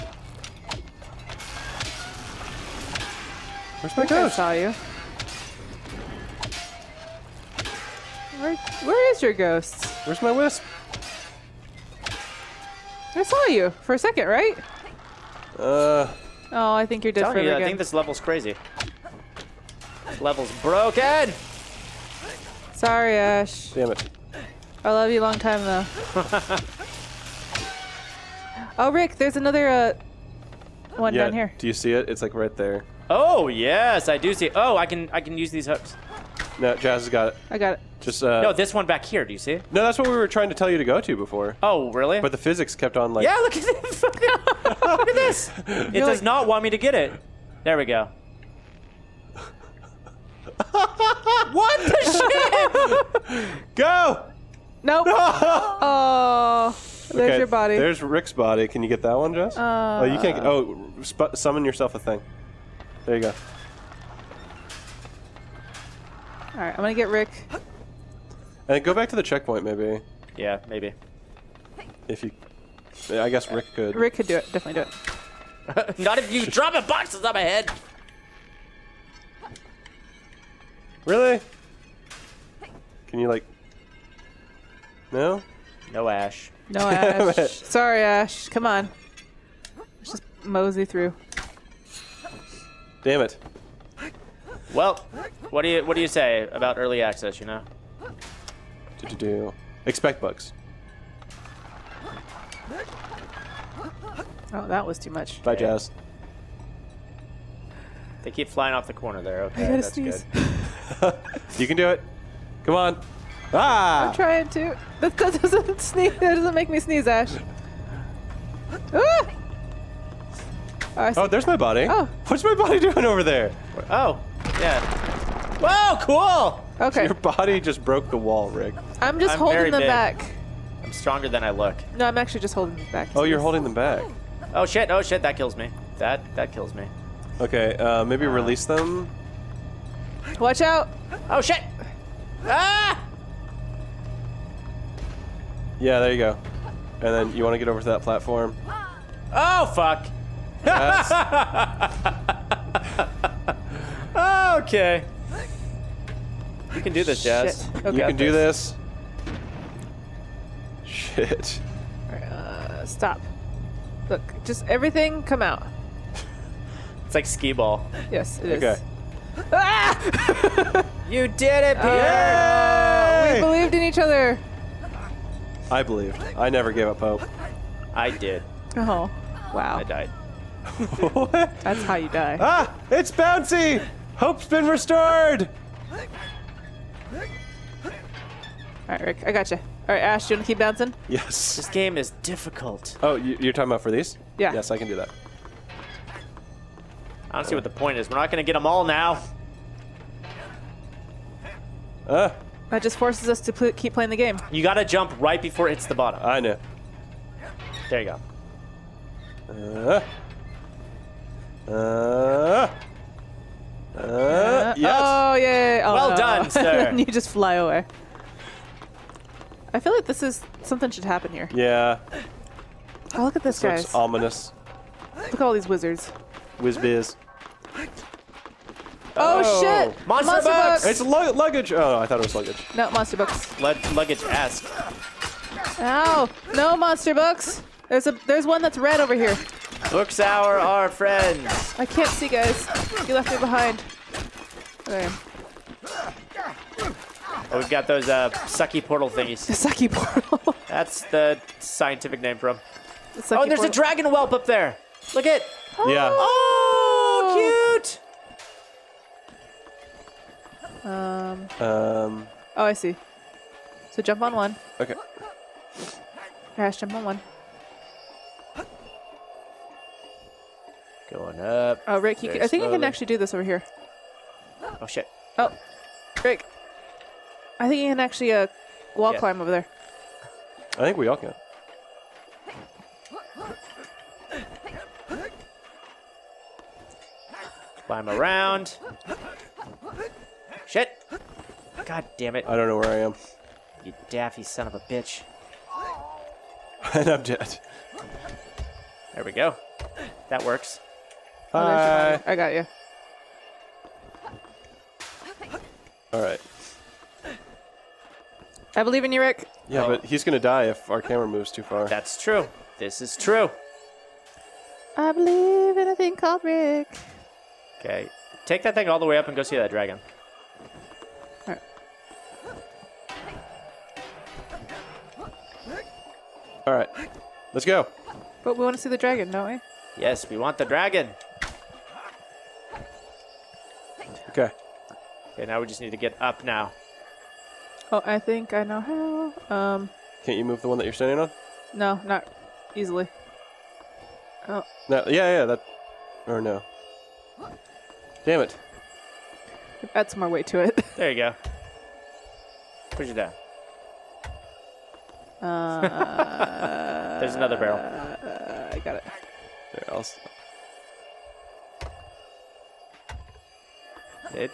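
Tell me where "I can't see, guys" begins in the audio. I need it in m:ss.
4:01.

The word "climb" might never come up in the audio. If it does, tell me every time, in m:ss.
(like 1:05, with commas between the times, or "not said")
4:39, 4:47.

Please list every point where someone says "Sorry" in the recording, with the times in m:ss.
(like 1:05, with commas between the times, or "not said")
0:22, 1:27.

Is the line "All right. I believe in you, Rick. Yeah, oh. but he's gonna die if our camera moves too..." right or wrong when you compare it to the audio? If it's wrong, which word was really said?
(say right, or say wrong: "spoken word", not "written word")
right.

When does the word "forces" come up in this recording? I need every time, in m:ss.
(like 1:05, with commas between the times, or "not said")
3:22.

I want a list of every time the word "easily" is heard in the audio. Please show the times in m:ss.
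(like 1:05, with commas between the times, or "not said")
5:42.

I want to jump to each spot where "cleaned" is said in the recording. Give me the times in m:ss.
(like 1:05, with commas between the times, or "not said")
not said.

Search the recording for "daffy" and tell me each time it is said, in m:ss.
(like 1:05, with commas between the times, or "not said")
4:54.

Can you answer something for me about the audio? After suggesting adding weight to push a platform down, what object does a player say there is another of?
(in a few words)
barrel.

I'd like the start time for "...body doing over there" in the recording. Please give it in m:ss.
2:02.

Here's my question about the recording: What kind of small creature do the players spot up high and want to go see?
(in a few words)
dragon whelp.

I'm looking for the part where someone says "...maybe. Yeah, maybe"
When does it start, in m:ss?
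1:09.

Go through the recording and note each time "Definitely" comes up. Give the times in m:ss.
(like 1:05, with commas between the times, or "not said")
1:14.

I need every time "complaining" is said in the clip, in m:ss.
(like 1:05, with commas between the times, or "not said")
not said.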